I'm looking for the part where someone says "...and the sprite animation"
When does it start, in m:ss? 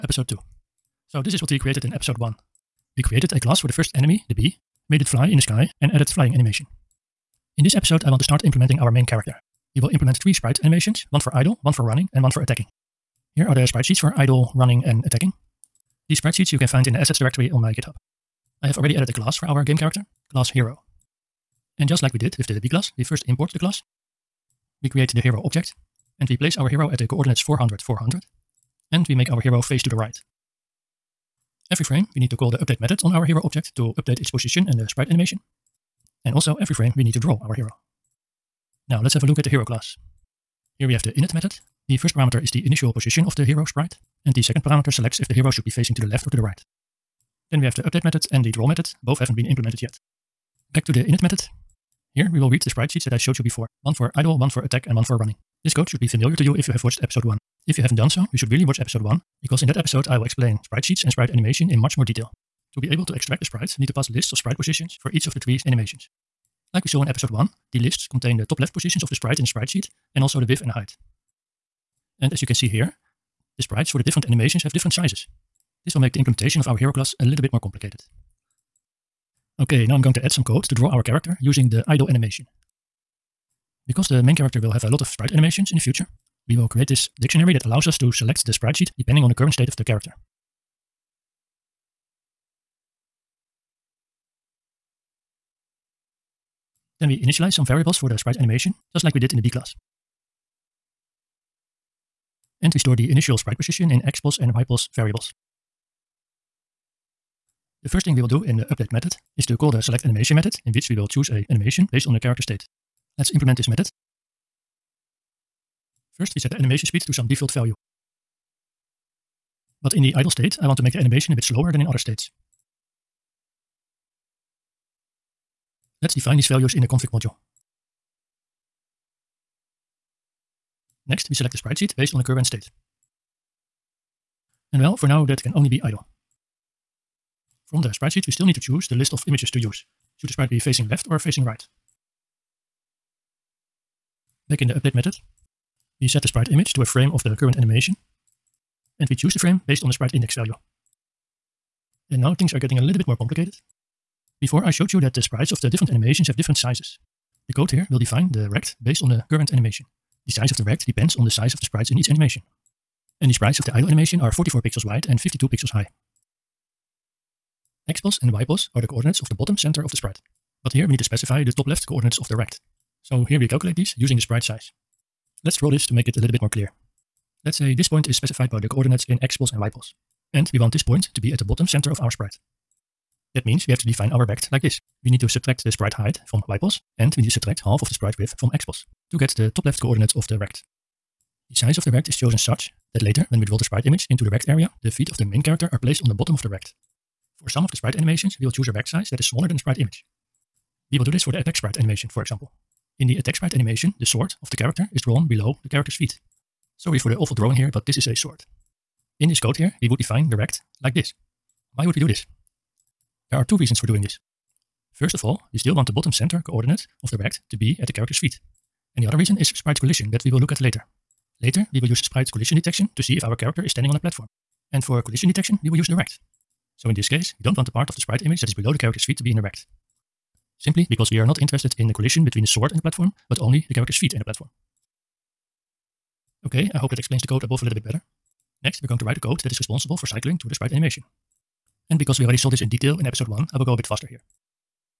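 0:34.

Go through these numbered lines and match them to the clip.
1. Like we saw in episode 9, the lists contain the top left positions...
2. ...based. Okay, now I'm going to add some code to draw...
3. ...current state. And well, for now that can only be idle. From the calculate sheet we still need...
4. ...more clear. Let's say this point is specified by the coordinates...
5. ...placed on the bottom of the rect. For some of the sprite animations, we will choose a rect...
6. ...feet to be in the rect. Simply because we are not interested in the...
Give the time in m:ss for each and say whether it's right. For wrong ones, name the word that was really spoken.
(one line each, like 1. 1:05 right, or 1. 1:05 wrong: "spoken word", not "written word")
1. 1:06 wrong: "1", not "9"
2. 1:17 wrong: "complicated", not "based"
3. 2:12 wrong: "sprite", not "calculate"
4. 2:56 right
5. 3:15 right
6. 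3:49 right.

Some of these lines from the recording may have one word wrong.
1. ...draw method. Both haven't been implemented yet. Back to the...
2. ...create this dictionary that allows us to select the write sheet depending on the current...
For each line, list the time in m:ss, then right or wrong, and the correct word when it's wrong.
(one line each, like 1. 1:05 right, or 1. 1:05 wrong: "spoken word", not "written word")
1. 0:48 right
2. 1:26 wrong: "sprite", not "write".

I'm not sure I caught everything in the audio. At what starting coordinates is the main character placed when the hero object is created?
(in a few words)
400, 400.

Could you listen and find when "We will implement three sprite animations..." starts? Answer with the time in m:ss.
0:09.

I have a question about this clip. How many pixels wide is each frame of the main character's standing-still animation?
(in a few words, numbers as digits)
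44.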